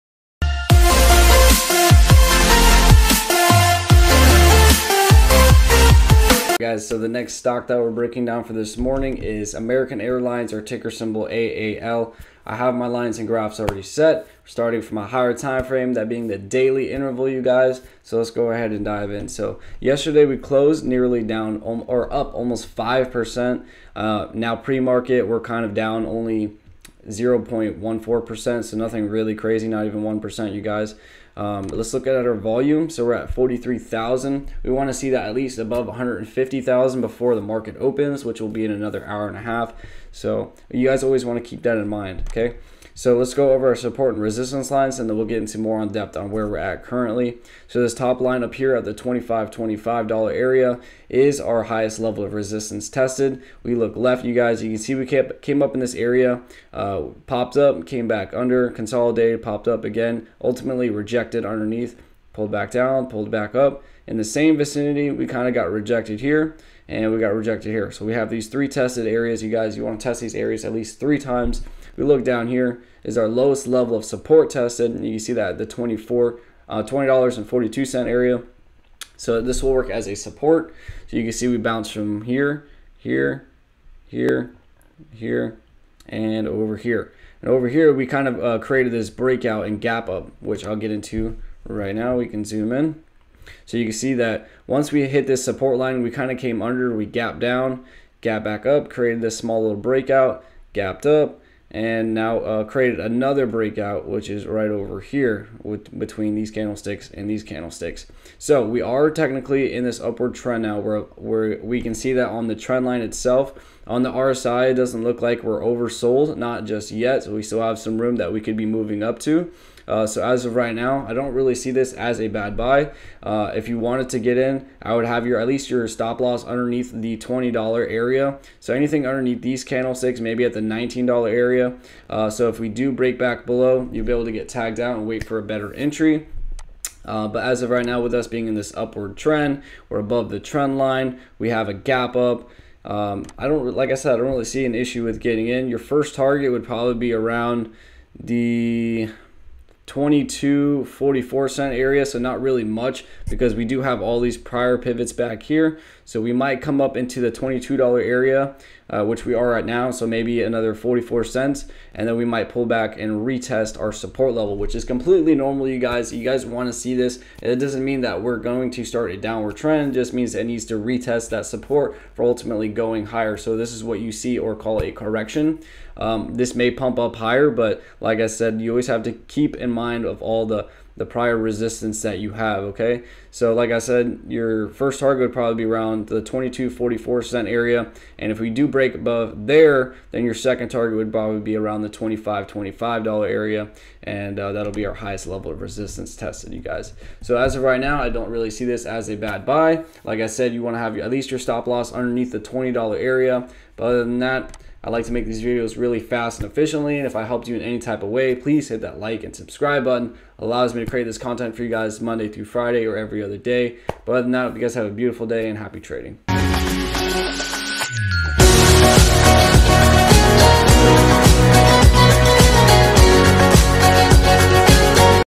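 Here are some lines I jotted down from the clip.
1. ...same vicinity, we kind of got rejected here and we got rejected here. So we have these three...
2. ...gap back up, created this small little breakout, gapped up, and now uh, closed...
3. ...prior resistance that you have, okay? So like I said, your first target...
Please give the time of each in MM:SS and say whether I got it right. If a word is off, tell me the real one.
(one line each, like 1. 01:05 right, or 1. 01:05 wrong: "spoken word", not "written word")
1. 01:04 right
2. 01:38 wrong: "created", not "closed"
3. 03:01 right.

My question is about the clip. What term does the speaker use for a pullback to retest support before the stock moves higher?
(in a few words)
correction.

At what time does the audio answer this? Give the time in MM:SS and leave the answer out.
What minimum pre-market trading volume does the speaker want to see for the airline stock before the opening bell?
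00:35.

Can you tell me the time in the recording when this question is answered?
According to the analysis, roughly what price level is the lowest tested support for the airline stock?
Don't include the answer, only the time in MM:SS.
01:16.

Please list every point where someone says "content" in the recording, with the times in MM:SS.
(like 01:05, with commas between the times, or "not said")
03:31.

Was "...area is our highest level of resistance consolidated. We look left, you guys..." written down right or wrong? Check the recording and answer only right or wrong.
wrong.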